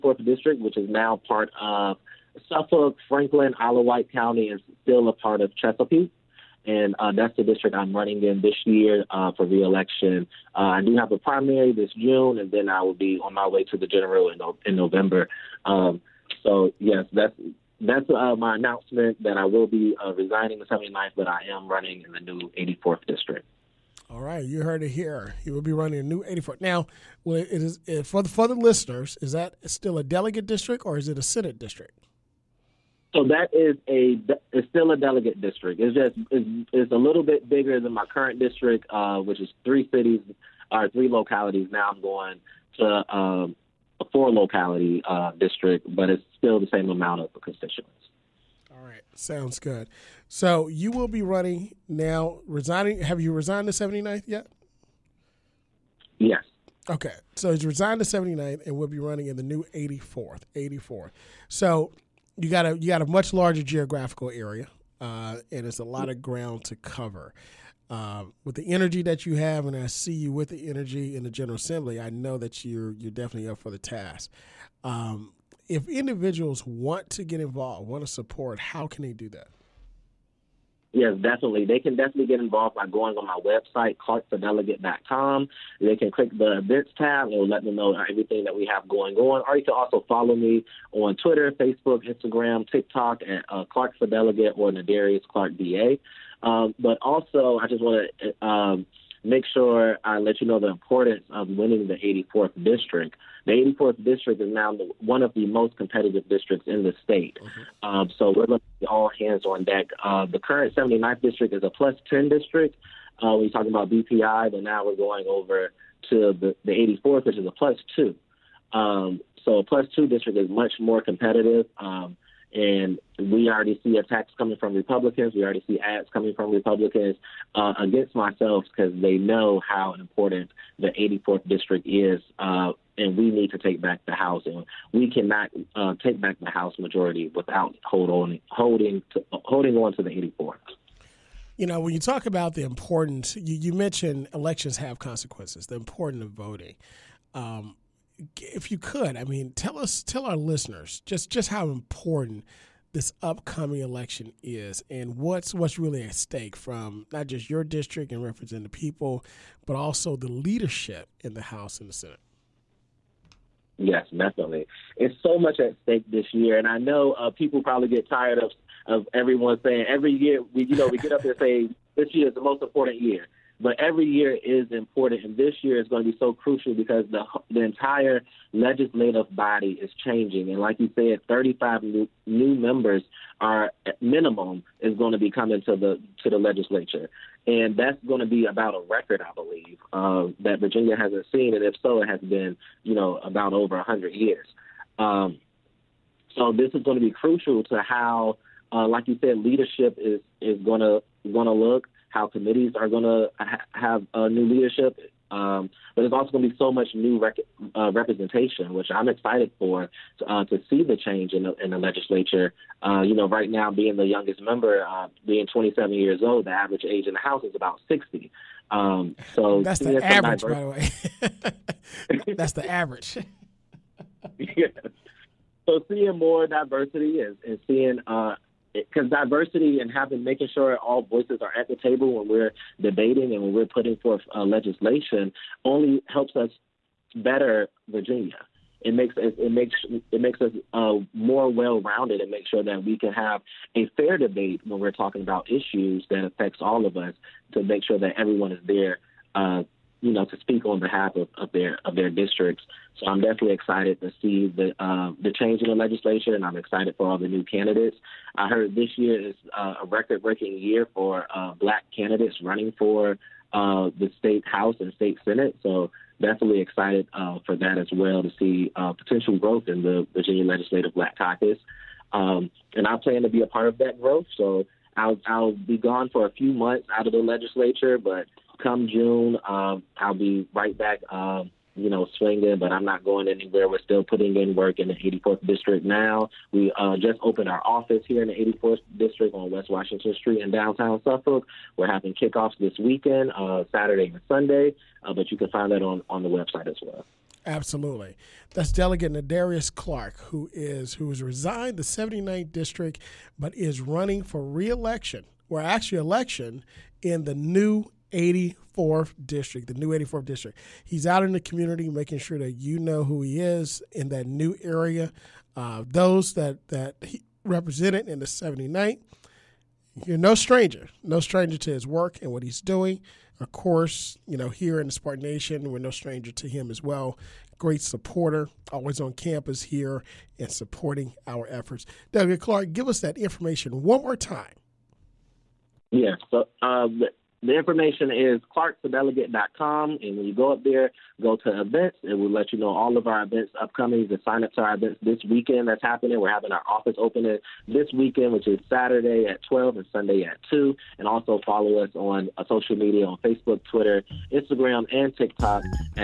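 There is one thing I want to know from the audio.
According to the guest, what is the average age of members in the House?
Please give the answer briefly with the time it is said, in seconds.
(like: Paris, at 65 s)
60, at 217 s.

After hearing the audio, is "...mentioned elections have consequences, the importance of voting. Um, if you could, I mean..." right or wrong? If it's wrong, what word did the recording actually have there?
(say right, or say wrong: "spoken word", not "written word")
right.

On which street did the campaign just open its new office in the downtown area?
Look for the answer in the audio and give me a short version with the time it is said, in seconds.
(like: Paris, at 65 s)
West Washington Street, at 289 s.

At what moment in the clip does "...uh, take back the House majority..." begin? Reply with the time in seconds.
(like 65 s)
135 s.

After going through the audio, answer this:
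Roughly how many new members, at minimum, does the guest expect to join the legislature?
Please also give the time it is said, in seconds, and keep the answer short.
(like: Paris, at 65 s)
35, at 181 s.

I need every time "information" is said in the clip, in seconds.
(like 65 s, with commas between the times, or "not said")
333 s, 337 s.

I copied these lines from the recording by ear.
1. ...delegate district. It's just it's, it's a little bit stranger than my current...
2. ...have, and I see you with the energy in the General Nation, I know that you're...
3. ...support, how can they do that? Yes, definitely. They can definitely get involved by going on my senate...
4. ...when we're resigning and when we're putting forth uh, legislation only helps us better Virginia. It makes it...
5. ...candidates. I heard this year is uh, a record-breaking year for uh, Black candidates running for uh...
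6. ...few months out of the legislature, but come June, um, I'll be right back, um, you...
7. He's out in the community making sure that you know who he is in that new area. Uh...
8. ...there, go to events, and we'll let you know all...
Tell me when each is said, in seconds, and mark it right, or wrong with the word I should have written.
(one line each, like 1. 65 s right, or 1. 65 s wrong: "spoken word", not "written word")
1. 34 s wrong: "bigger", not "stranger"
2. 69 s wrong: "Assembly", not "Nation"
3. 78 s wrong: "website", not "senate"
4. 232 s wrong: "debating", not "resigning"
5. 257 s right
6. 276 s right
7. 310 s right
8. 340 s right.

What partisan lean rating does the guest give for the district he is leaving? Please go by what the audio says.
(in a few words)
plus 10.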